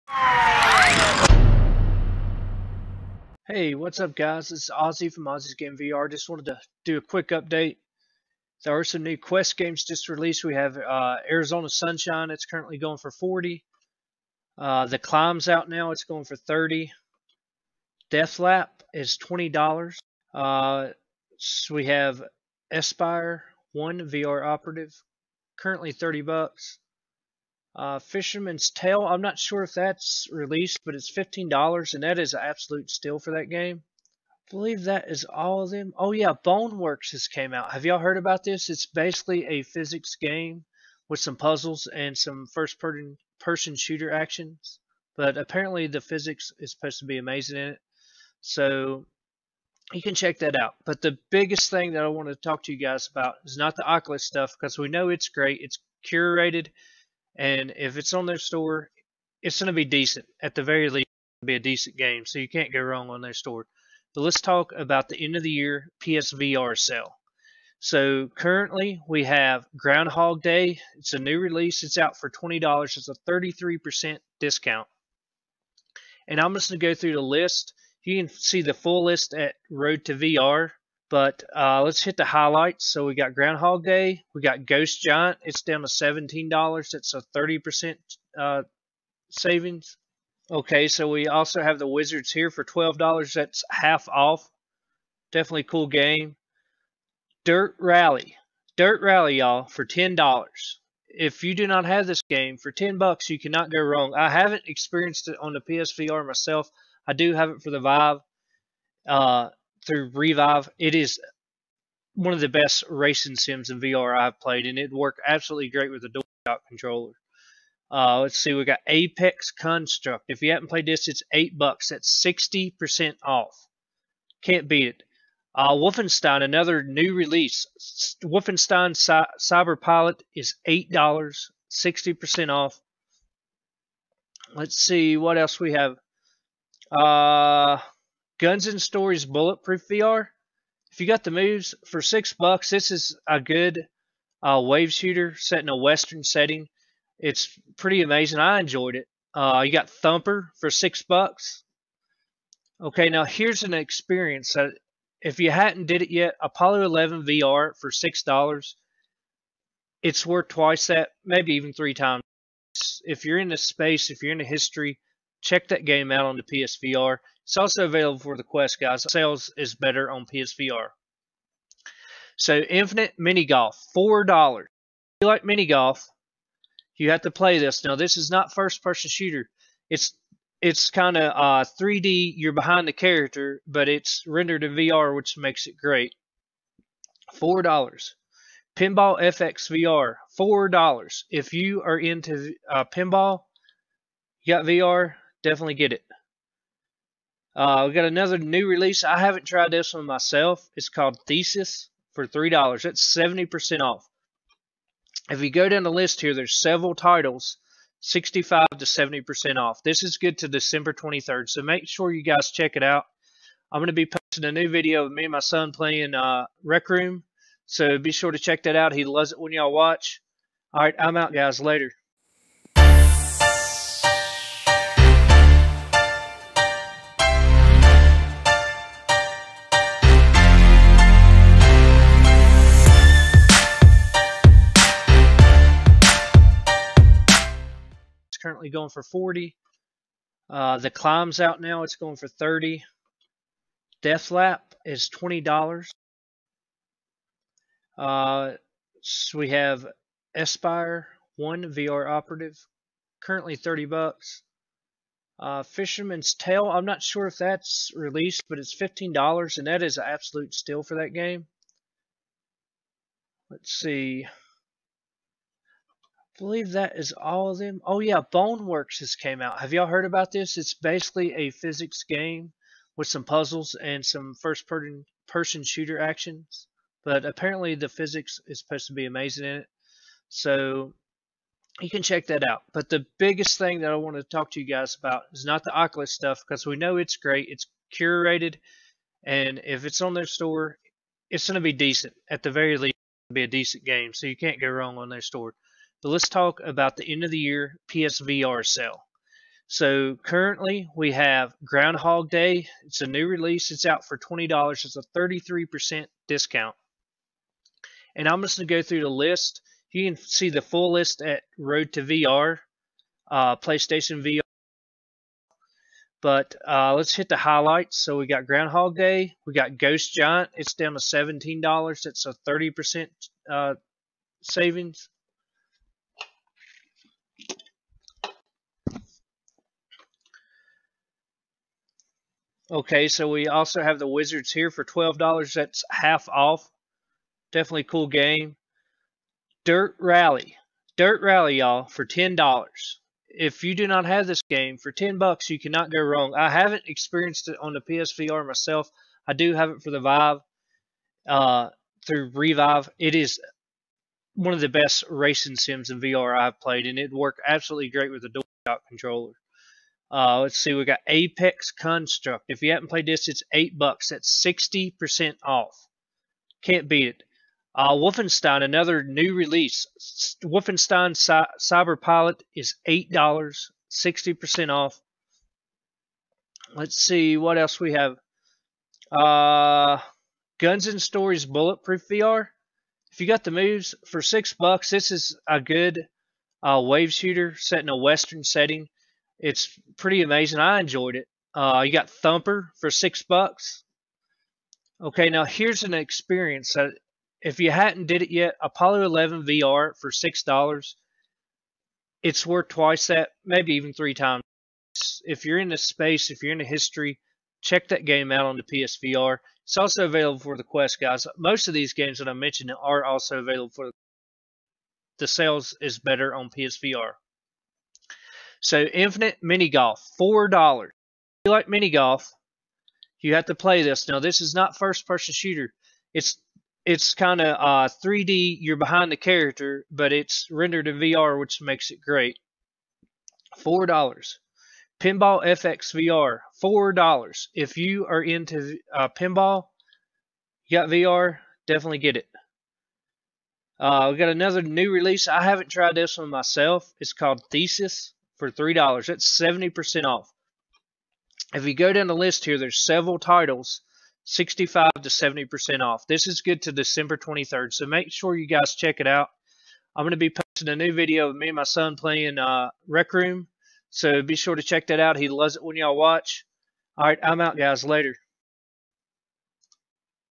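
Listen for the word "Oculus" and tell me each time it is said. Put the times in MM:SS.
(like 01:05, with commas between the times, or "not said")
00:53, 04:45.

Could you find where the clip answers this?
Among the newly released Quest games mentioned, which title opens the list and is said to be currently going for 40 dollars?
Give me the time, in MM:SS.
00:11.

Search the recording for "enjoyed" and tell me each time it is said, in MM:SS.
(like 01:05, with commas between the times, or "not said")
02:28, 06:30.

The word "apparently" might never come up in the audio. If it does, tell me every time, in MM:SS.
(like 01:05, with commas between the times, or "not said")
00:45, 04:37.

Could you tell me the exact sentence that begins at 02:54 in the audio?
If you like mini golf, you have to play this.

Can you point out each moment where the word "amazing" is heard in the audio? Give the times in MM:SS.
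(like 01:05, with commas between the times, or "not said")
00:47, 02:28, 04:39, 06:30.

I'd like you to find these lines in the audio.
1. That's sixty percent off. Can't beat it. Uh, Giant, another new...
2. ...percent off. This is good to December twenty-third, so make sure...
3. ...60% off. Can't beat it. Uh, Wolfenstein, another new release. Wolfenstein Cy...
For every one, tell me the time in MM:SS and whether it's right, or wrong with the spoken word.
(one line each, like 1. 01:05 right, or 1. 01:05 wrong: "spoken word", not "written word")
1. 02:01 wrong: "Wolfenstein", not "Giant"
2. 03:29 right
3. 06:04 right.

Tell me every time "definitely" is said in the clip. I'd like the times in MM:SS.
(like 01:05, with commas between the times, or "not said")
01:35, 03:15, 05:37, 07:21.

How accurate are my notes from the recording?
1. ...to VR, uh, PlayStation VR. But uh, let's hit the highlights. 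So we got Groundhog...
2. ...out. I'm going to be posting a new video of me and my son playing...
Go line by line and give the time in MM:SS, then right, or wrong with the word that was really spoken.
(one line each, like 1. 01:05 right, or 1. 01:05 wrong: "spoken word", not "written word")
1. 05:11 right
2. 07:39 right.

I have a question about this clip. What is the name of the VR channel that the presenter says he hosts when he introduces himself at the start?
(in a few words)
Ozzy's Game VR.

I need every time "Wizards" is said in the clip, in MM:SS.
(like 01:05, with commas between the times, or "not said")
01:31, 05:34.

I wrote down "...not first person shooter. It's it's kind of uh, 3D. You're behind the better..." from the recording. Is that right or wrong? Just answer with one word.
wrong.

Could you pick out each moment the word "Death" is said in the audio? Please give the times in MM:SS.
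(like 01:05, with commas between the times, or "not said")
00:18, 04:04.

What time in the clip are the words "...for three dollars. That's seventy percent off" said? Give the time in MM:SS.
03:22.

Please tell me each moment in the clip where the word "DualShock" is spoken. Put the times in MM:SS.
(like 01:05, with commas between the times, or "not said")
01:56, 05:58.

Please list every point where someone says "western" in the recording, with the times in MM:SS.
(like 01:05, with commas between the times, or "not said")
02:25, 06:27.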